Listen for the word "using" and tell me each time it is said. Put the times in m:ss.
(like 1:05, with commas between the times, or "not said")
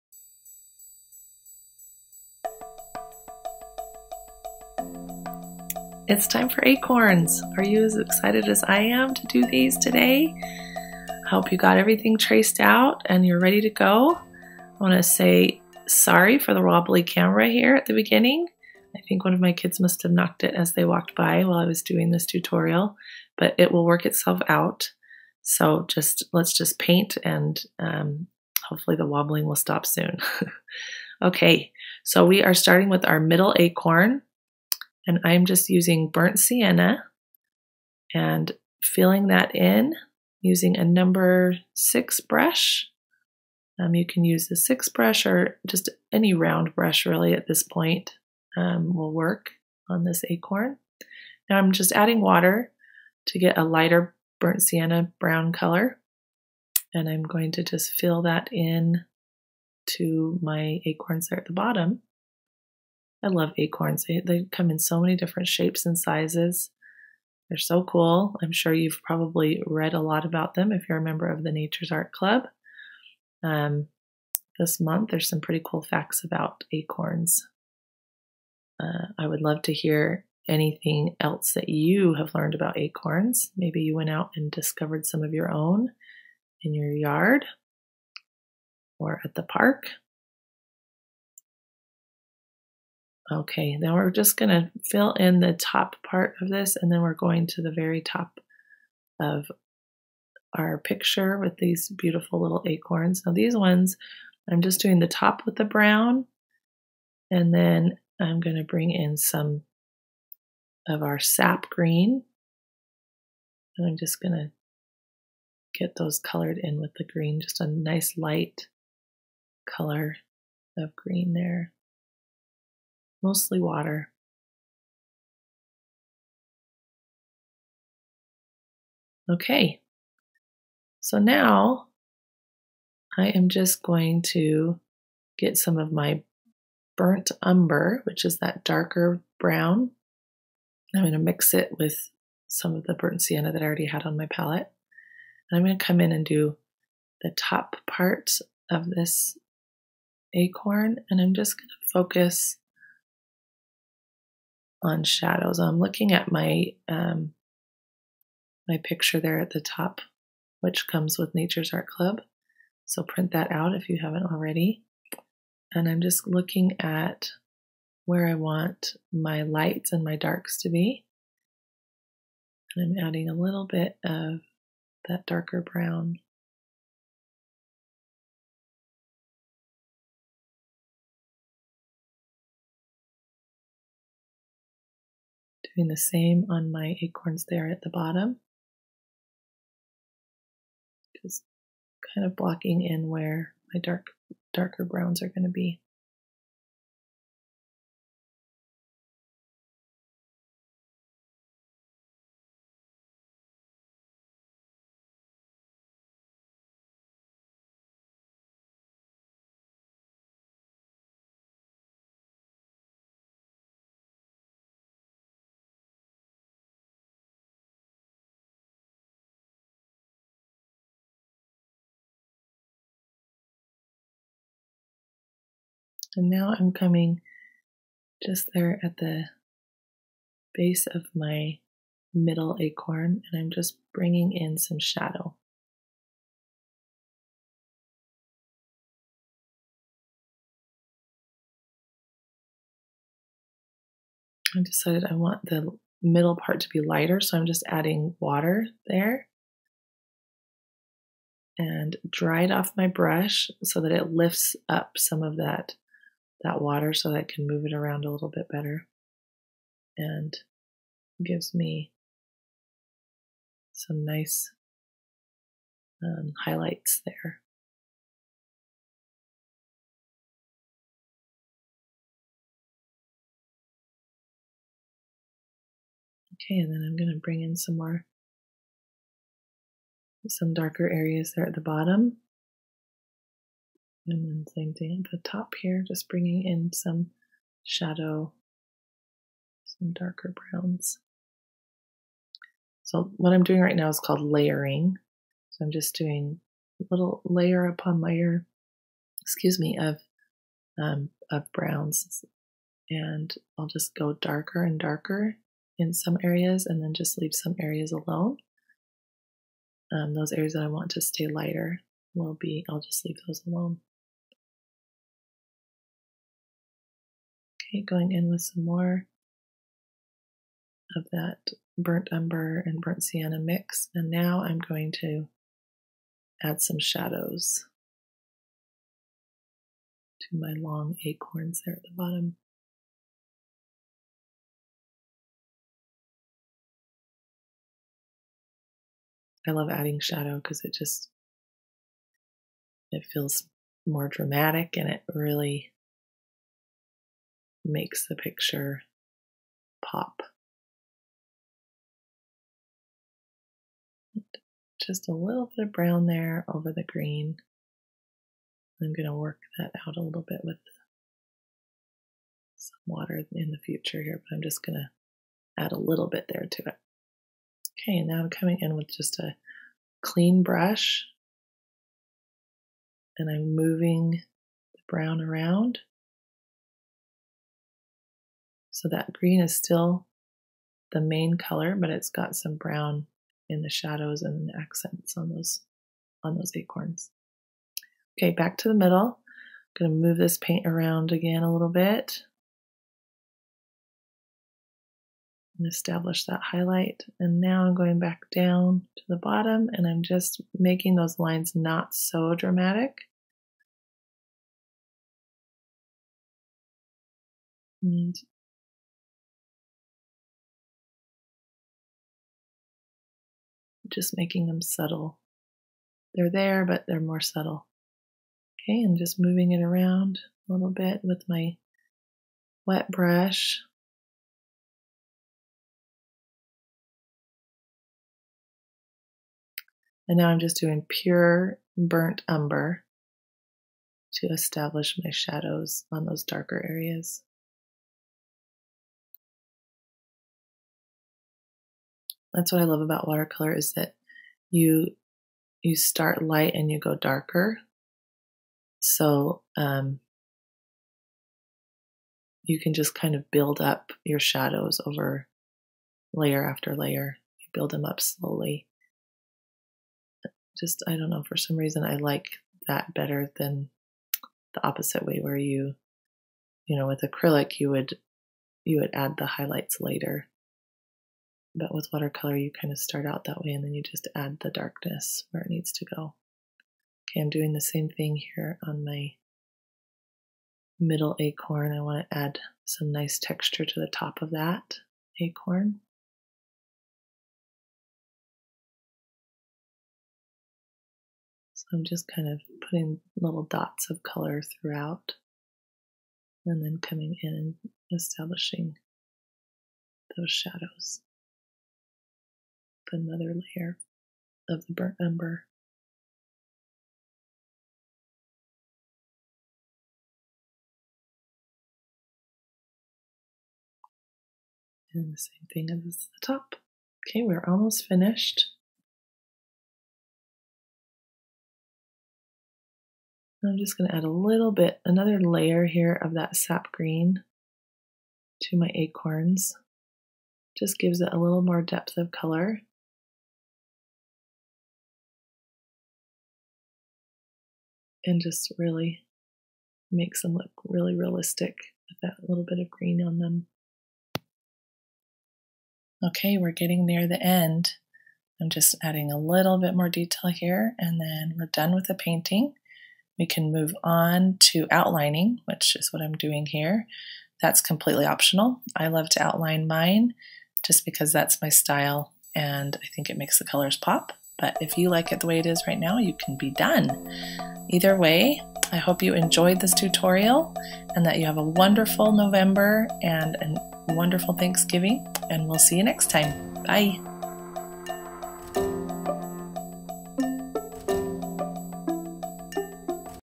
0:35, 0:40.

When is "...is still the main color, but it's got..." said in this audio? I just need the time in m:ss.
6:19.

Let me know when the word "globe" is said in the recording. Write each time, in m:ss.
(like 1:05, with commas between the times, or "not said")
not said.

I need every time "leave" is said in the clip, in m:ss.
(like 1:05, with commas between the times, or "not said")
5:07, 5:13.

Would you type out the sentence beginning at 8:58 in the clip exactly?
and just really makes them look really realistic with that little bit of green on them.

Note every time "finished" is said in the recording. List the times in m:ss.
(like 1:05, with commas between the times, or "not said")
8:37.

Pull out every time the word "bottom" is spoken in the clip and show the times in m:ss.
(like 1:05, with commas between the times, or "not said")
1:01, 3:07, 4:41, 5:31, 6:39.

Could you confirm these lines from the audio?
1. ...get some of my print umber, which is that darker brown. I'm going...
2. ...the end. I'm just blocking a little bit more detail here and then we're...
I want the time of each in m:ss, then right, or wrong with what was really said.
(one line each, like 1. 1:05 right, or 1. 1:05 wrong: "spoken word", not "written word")
1. 2:15 wrong: "burnt", not "print"
2. 9:07 wrong: "adding", not "blocking".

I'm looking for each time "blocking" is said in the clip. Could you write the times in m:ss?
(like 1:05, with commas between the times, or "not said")
3:12.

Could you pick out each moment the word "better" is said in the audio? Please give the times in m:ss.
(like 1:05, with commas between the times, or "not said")
4:18, 7:42.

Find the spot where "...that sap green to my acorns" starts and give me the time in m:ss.
8:46.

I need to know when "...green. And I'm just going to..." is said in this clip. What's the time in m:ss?
1:51.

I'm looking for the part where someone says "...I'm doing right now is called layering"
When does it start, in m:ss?
4:53.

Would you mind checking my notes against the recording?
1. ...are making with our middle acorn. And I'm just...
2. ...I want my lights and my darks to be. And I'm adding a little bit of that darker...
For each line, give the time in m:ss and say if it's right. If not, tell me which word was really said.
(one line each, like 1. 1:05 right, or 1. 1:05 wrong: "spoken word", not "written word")
1. 0:32 wrong: "starting", not "making"
2. 2:48 right.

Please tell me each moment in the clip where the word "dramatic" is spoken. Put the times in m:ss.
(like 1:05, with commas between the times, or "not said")
5:44, 6:42.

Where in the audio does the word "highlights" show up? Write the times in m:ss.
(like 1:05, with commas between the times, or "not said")
4:26, 6:36, 7:49.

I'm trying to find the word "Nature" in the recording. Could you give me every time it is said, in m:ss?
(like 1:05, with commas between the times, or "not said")
1:11, 2:41.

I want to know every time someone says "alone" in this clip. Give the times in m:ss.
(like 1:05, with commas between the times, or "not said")
5:07, 5:13.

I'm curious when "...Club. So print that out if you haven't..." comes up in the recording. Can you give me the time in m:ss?
2:41.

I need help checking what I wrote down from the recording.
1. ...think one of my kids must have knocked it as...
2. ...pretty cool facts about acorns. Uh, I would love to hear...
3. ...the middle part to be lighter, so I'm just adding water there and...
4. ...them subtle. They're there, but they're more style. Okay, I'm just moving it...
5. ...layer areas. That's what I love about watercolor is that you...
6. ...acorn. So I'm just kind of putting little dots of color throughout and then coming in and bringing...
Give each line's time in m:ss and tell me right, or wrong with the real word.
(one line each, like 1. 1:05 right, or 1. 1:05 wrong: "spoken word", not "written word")
1. 0:19 right
2. 1:15 right
3. 4:05 right
4. 6:54 wrong: "subtle", not "style"
5. 7:16 wrong: "darker", not "layer"
6. 8:05 wrong: "establishing", not "bringing".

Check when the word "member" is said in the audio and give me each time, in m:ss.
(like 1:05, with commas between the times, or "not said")
1:11.